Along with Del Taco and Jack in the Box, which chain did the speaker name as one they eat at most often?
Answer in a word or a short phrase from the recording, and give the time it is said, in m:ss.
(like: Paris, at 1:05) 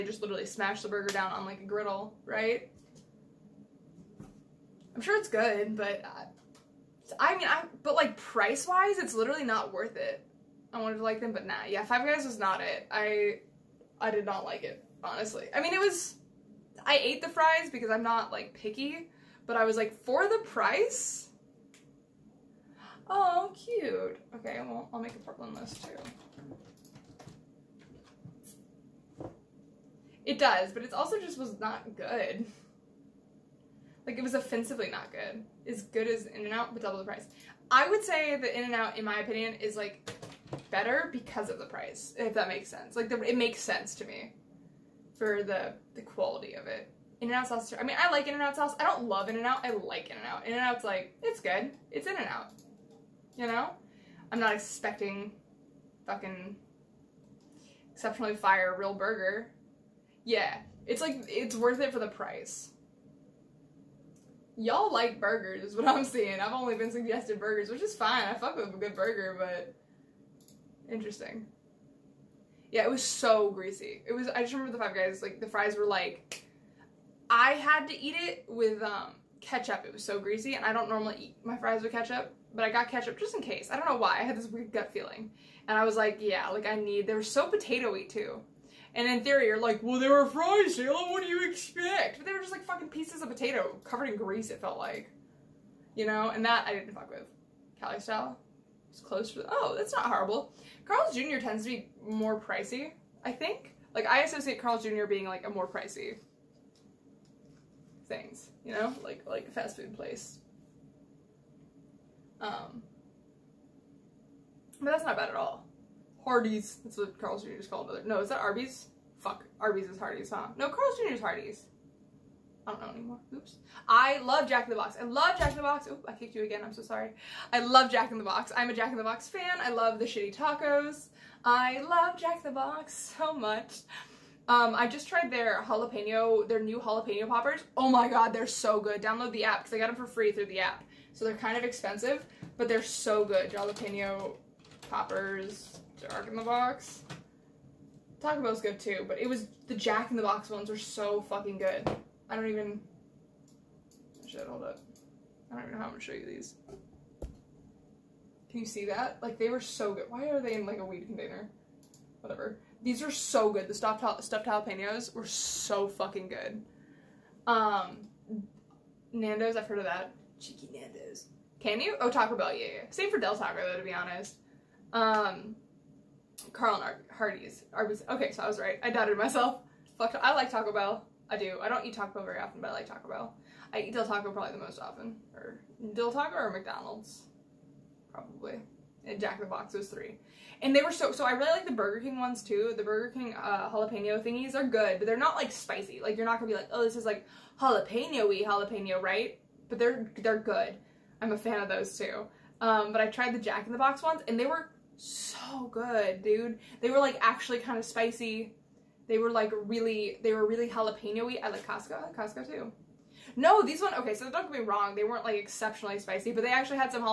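McDonald's, at 3:06.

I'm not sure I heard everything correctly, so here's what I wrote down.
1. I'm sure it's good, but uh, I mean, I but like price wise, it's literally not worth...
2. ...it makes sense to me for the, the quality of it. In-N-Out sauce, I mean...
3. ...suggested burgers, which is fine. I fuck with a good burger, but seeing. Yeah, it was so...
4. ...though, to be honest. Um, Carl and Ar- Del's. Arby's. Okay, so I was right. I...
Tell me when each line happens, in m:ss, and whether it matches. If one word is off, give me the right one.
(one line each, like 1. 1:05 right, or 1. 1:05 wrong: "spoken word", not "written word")
1. 0:04 right
2. 0:43 right
3. 1:06 wrong: "interesting", not "seeing"
4. 2:53 wrong: "Hardee", not "Del".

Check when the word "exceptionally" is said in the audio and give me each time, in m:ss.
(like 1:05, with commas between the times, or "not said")
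0:57, 3:35.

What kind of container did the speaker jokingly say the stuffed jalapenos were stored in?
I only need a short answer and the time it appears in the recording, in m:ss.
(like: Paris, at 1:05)
a weed container, at 2:40.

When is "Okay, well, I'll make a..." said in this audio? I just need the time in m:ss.
0:24.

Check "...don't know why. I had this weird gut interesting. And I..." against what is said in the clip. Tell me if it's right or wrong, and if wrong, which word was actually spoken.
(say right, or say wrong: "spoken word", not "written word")
wrong: "feeling", not "interesting".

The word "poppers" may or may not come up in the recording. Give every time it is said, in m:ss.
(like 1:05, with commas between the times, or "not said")
2:17, 2:24.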